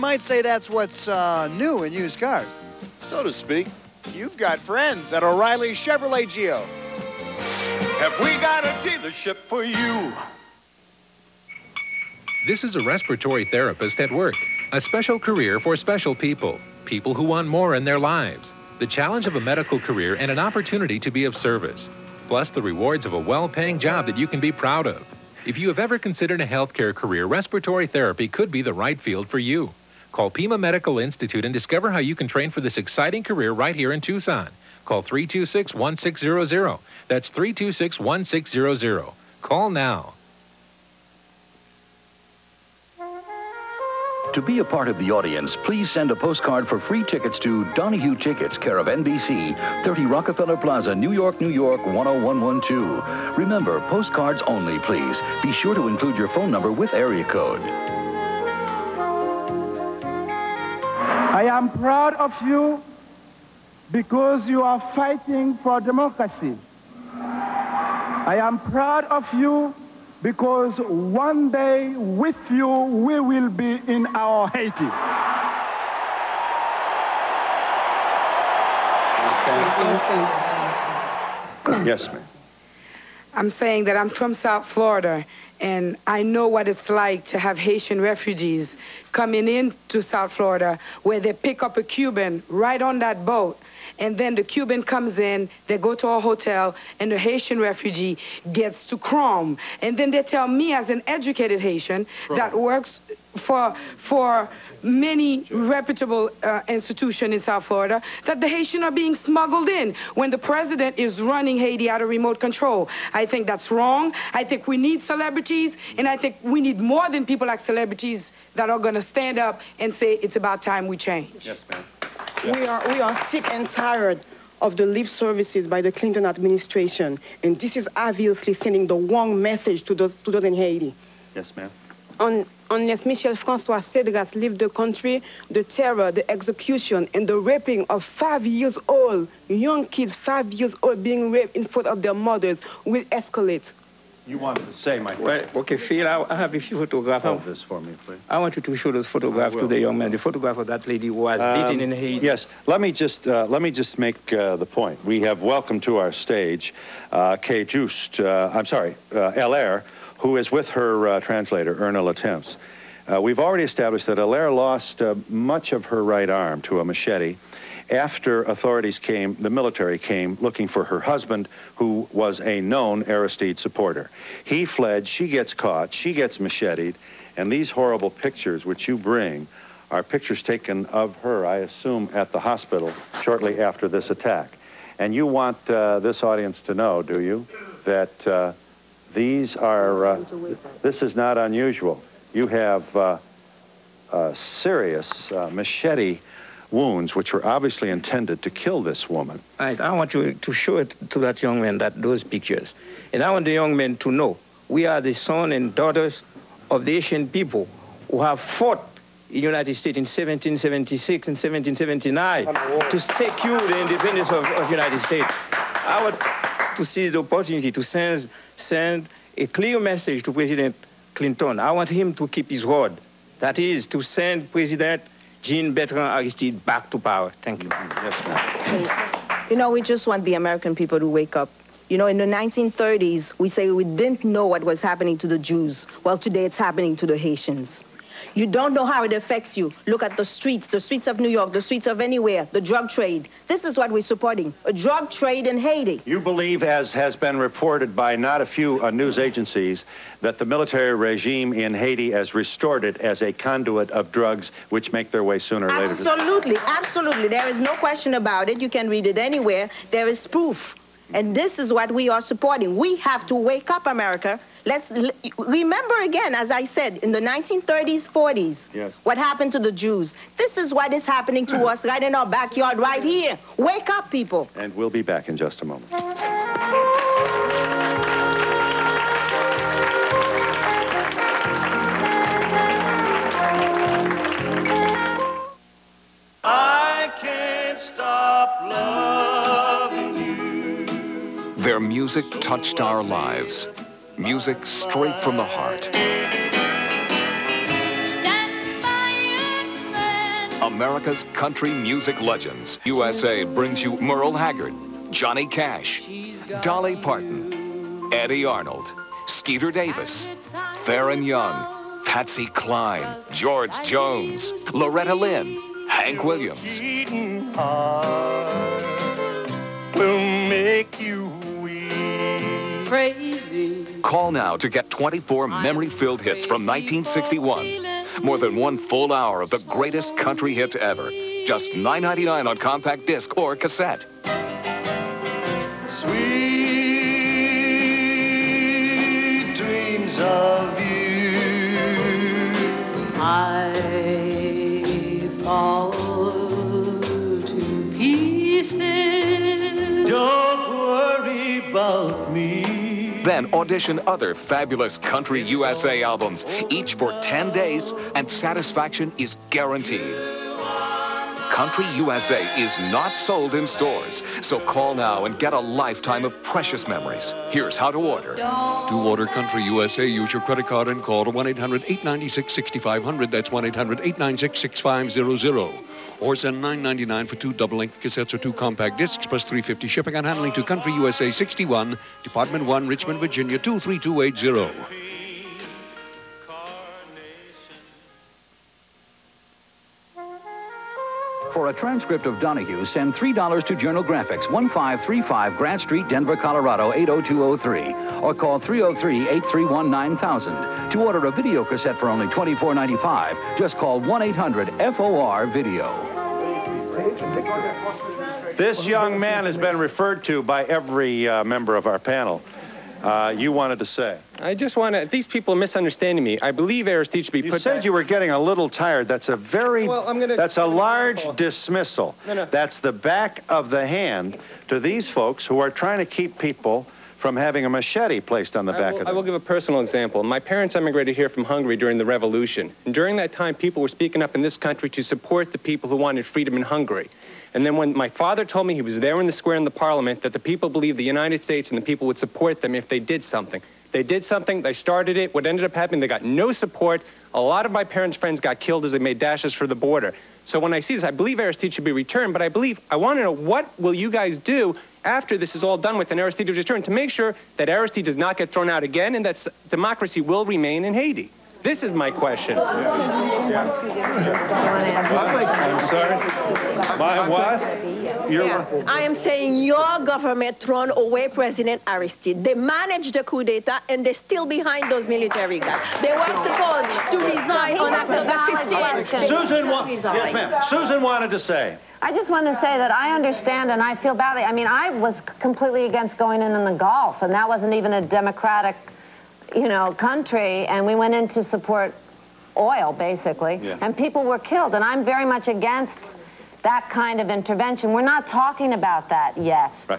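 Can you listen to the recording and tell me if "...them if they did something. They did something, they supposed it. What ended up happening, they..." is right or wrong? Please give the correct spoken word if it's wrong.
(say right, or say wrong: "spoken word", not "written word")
wrong: "started", not "supposed".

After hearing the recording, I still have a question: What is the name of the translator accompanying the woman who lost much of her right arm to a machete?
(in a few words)
Erna Latemps.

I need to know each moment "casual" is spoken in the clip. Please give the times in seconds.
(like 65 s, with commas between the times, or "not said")
not said.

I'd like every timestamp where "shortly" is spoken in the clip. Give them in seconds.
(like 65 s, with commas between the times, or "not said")
183 s.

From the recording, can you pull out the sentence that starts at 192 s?
You have uh, serious uh, machete wounds, which were obviously intended to kill this woman.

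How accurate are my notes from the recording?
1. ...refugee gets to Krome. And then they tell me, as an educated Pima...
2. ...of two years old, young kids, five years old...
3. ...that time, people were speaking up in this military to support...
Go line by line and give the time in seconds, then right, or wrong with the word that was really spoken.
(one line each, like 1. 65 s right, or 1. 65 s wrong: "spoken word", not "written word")
1. 97 s wrong: "Haitian", not "Pima"
2. 137 s wrong: "five", not "two"
3. 433 s wrong: "country", not "military".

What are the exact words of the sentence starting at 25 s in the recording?
If you have ever considered a healthcare career, respiratory therapy could be the right field for you.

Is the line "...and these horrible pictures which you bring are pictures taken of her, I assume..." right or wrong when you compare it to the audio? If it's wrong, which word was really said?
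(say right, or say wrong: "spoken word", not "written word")
right.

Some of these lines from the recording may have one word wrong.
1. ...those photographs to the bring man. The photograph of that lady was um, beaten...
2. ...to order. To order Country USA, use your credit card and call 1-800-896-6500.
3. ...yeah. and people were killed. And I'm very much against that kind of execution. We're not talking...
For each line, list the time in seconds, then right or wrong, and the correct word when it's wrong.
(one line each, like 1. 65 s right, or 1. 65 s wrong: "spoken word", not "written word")
1. 148 s wrong: "young", not "bring"
2. 367 s right
3. 493 s wrong: "intervention", not "execution".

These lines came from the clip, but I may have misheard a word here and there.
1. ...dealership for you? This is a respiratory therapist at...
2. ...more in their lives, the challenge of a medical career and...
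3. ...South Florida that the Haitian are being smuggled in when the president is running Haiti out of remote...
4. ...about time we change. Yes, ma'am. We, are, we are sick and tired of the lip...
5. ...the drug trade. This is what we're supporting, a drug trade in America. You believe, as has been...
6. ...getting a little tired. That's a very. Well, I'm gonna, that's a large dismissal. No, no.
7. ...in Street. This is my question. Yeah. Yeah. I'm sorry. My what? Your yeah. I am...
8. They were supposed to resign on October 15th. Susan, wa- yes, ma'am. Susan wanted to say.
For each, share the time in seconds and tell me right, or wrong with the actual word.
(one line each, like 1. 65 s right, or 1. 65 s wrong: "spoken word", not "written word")
1. 8 s right
2. 17 s right
3. 107 s right
4. 120 s right
5. 242 s wrong: "Haiti", not "America"
6. 418 s right
7. 460 s wrong: "Haiti", not "Street"
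8. 476 s right.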